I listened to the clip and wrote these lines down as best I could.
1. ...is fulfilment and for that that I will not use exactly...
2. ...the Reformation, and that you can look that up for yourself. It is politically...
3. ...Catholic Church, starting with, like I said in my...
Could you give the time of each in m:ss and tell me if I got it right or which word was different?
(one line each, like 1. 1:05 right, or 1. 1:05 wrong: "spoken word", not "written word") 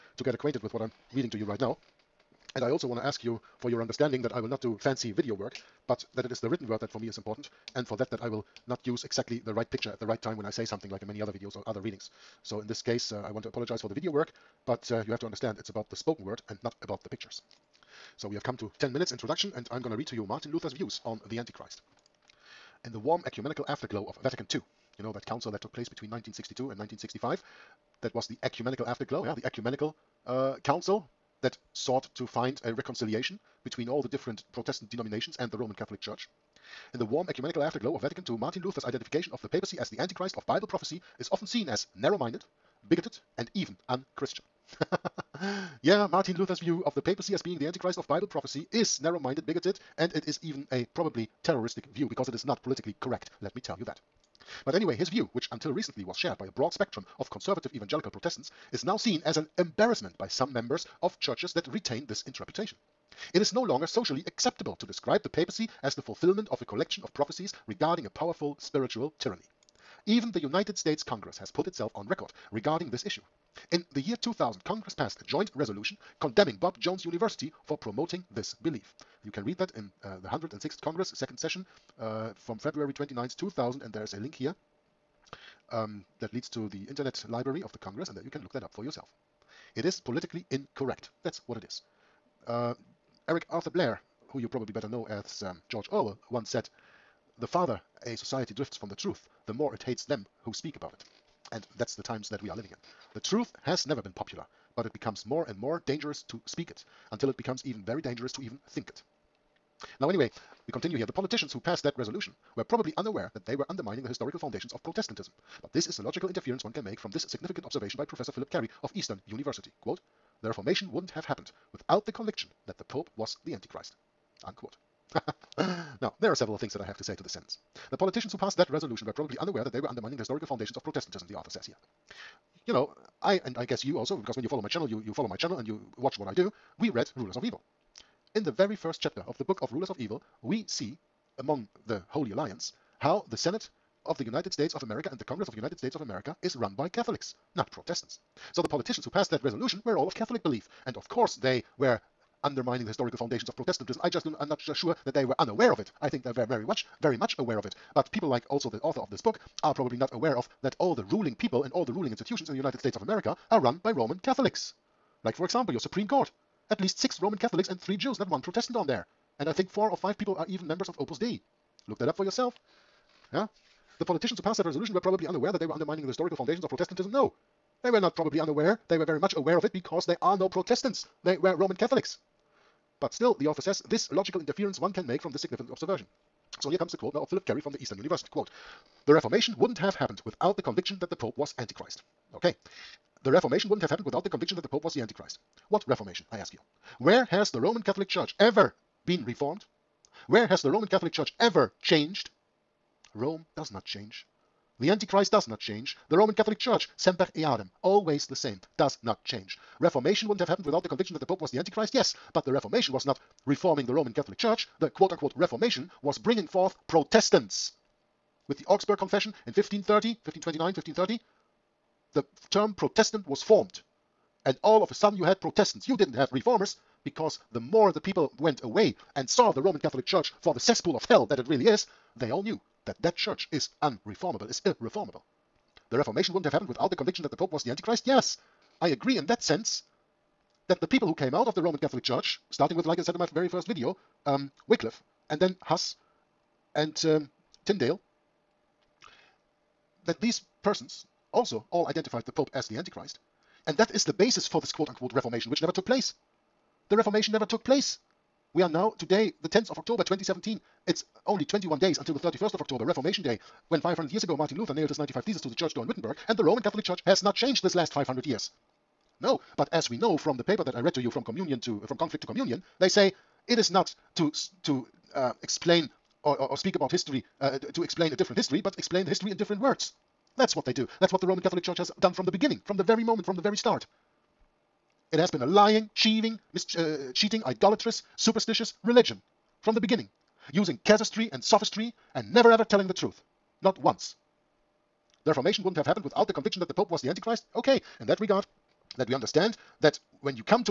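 1. 0:07 wrong: "important", not "fulfilment"
2. 1:27 wrong: "Congress", not "Reformation"
3. 4:01 right.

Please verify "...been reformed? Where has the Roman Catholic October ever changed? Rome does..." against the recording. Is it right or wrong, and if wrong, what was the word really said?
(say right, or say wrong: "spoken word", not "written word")
wrong: "Church", not "October".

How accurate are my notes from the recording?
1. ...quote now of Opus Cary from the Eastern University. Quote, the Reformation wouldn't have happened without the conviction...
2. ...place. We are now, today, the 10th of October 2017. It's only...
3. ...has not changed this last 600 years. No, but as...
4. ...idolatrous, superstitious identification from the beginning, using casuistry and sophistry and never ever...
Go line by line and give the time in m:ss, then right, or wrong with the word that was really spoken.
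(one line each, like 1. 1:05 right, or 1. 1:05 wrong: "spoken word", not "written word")
1. 3:06 wrong: "Phillip", not "Opus"
2. 4:17 right
3. 4:27 wrong: "500", not "600"
4. 4:47 wrong: "religion", not "identification".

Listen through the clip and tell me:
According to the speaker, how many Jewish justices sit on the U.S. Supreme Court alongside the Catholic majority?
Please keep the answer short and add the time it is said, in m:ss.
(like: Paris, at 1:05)
3, at 2:47.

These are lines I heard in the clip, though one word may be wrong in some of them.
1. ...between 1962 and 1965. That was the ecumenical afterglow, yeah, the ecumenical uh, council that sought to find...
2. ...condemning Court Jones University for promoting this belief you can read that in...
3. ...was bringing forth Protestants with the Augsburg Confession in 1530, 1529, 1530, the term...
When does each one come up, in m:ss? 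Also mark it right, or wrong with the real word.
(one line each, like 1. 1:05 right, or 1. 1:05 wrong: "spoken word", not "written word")
1. 0:25 right
2. 1:16 wrong: "Bob", not "Court"
3. 3:36 right.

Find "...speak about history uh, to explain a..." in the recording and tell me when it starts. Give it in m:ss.
4:36.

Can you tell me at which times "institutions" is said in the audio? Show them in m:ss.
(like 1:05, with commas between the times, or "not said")
2:42.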